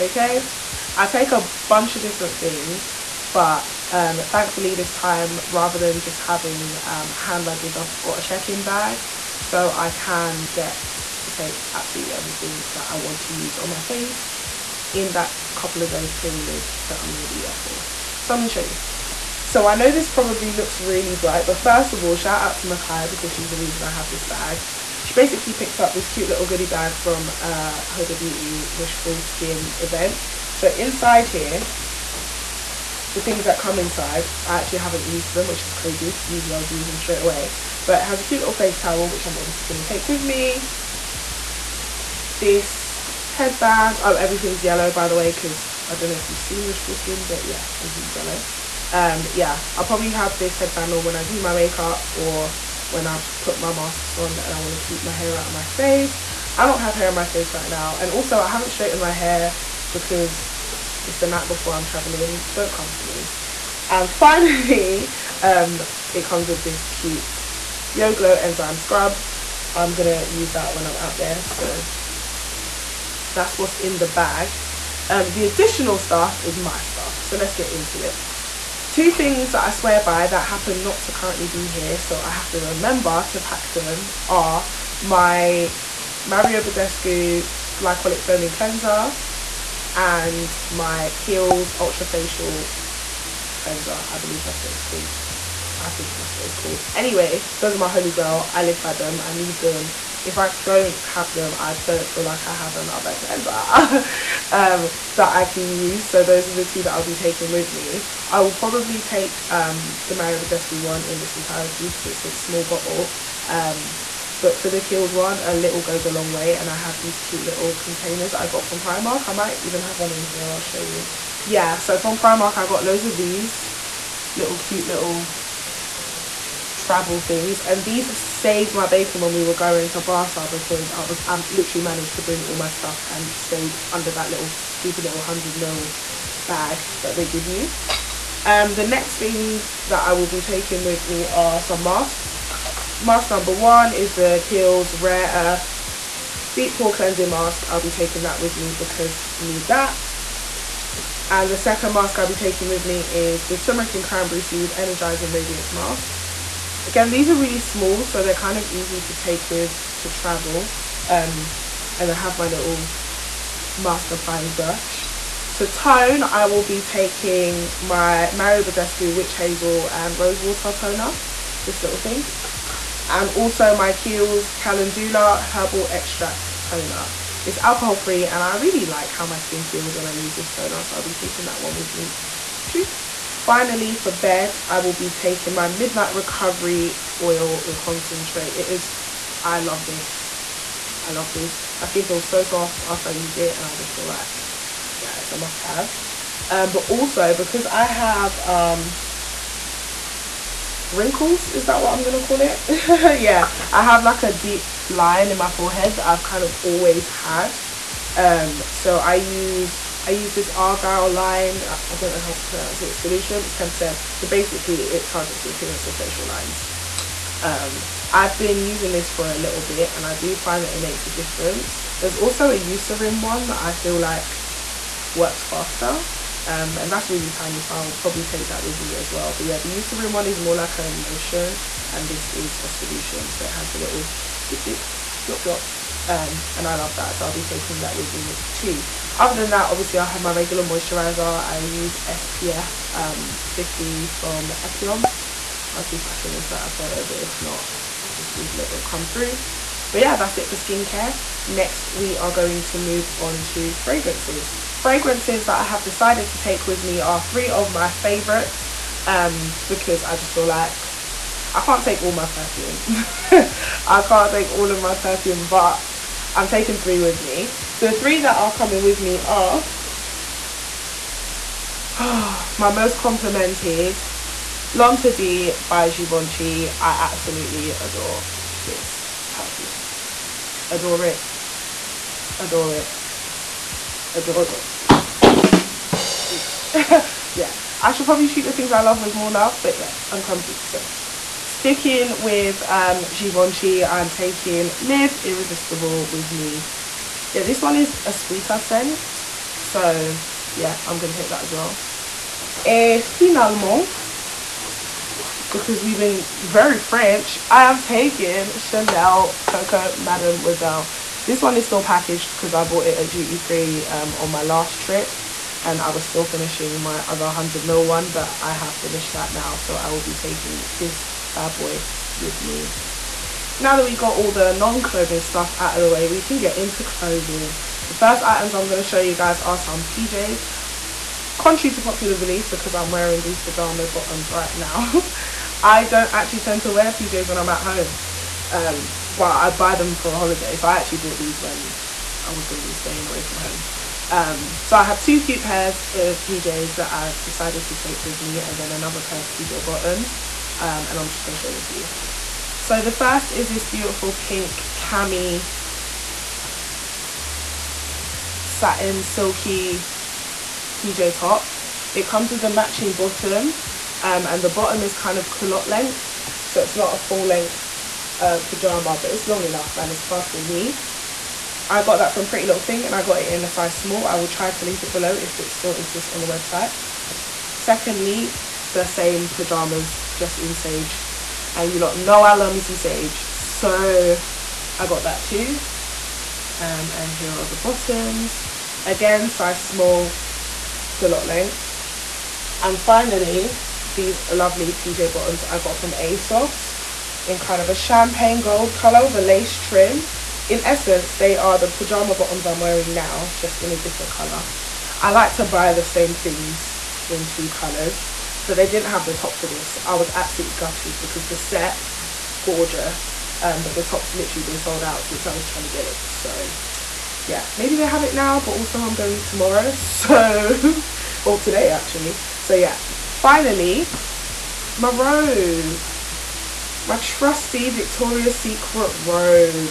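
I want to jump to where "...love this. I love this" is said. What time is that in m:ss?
3:09.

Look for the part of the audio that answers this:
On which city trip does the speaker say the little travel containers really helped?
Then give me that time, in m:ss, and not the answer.
2:10.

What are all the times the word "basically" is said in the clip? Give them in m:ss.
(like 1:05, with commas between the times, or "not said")
0:25, 3:34.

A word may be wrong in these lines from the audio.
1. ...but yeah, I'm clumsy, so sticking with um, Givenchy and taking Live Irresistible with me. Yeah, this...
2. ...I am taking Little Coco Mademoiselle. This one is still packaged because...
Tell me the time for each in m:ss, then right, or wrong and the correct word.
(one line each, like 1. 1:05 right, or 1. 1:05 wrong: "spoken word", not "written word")
1. 4:49 right
2. 5:07 wrong: "Chanel", not "Little".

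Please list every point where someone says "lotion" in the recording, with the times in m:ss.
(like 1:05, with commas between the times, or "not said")
3:50.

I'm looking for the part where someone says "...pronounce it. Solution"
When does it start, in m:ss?
3:32.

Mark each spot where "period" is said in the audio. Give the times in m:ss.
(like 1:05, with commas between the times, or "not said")
0:16.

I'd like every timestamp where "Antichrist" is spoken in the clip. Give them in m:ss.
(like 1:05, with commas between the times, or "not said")
not said.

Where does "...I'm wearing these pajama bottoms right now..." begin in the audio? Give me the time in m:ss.
5:32.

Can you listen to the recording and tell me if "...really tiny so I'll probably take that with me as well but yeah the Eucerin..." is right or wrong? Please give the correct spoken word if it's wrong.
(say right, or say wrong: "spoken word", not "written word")
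right.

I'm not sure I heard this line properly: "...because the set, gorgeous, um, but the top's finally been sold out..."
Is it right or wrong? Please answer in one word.
wrong.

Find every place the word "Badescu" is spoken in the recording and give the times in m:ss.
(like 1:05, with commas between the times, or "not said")
1:26, 1:50, 2:48.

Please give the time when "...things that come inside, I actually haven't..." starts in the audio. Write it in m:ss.
0:33.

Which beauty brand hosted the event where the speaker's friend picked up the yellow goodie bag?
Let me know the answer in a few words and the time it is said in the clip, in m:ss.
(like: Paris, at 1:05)
Huda Beauty, at 0:27.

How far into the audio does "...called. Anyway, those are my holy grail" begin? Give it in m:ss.
1:36.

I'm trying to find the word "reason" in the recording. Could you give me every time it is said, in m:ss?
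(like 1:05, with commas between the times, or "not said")
0:23.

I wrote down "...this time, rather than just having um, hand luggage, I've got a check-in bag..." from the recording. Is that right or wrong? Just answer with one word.
right.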